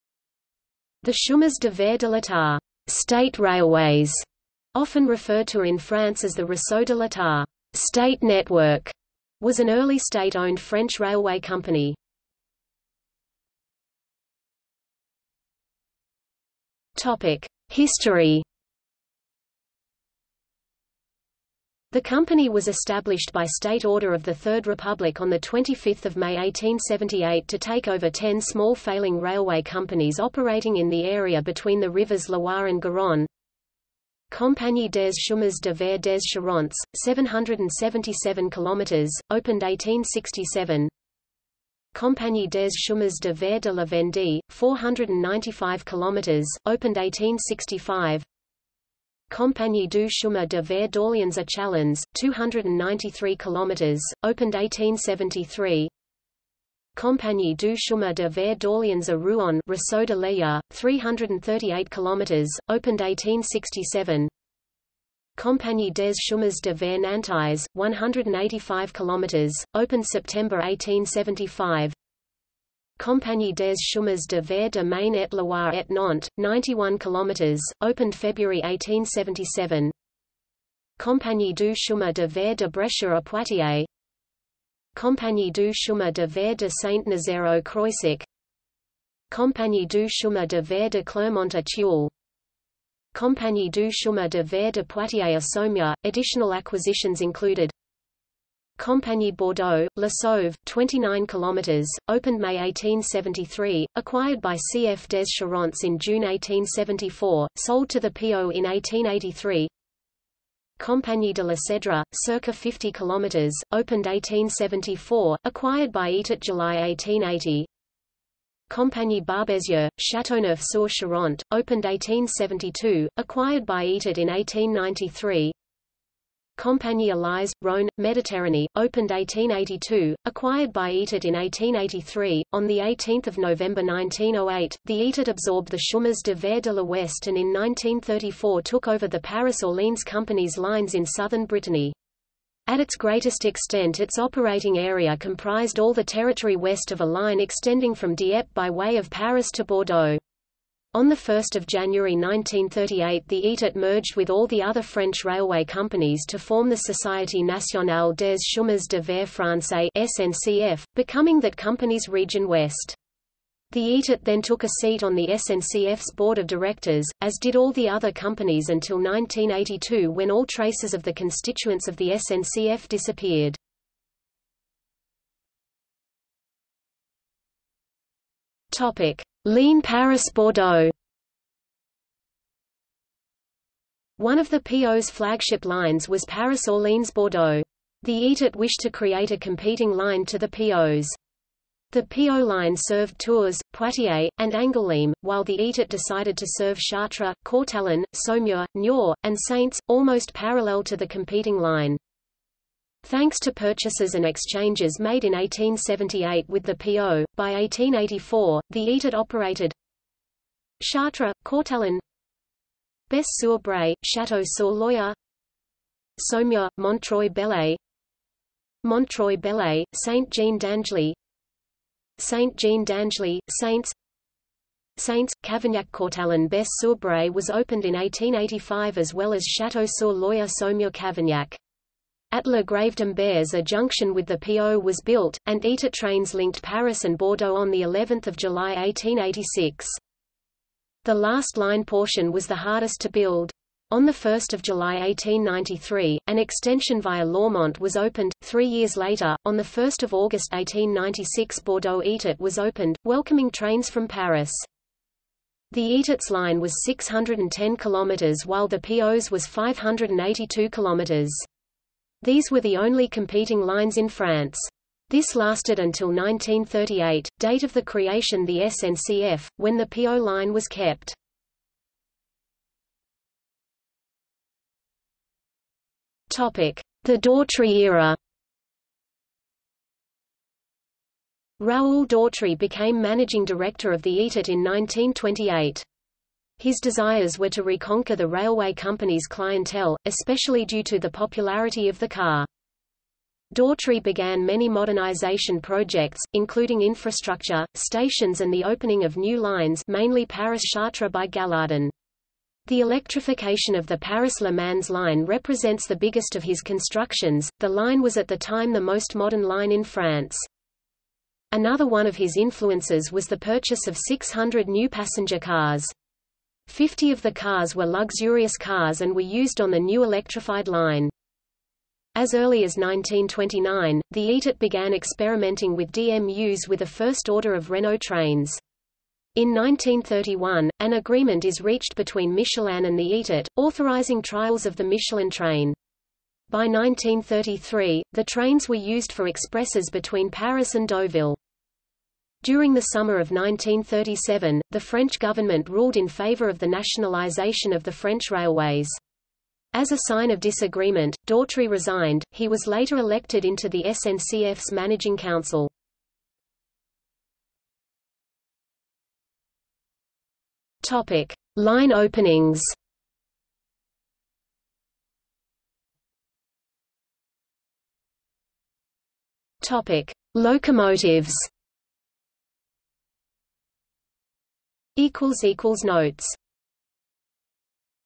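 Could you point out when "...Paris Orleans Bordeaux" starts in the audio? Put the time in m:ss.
3:06.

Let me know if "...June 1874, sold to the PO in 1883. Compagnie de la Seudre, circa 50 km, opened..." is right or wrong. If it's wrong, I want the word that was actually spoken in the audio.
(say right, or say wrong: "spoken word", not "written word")
right.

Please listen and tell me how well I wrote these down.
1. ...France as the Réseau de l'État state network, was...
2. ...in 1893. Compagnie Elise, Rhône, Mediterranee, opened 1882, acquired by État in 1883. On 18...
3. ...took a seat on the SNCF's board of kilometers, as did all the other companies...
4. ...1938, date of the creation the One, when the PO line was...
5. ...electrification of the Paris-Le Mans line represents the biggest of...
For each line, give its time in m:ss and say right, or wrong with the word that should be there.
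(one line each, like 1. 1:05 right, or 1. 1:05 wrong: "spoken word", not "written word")
1. 0:05 right
2. 2:04 right
3. 2:44 wrong: "directors", not "kilometers"
4. 4:26 wrong: "SNCF", not "One"
5. 5:02 right.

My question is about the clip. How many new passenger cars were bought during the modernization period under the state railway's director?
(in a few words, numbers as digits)
600.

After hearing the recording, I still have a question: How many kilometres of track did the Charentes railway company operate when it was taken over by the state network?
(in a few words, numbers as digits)
777 km.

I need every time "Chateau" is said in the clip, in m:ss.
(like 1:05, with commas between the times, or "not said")
3:34, 3:49.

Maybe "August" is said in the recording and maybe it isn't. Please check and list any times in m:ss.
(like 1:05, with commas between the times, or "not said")
4:10.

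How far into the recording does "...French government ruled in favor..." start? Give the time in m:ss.
5:44.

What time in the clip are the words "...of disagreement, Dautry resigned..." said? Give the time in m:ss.
5:50.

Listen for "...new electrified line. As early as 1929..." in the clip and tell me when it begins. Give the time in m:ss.
5:19.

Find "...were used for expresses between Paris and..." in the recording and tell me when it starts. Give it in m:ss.
5:38.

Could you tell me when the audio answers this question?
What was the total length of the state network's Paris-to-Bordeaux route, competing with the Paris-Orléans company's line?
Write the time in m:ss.
4:16.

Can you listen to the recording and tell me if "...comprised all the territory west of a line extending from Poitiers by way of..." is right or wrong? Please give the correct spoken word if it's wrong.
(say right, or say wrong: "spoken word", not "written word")
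wrong: "Dieppe", not "Poitiers".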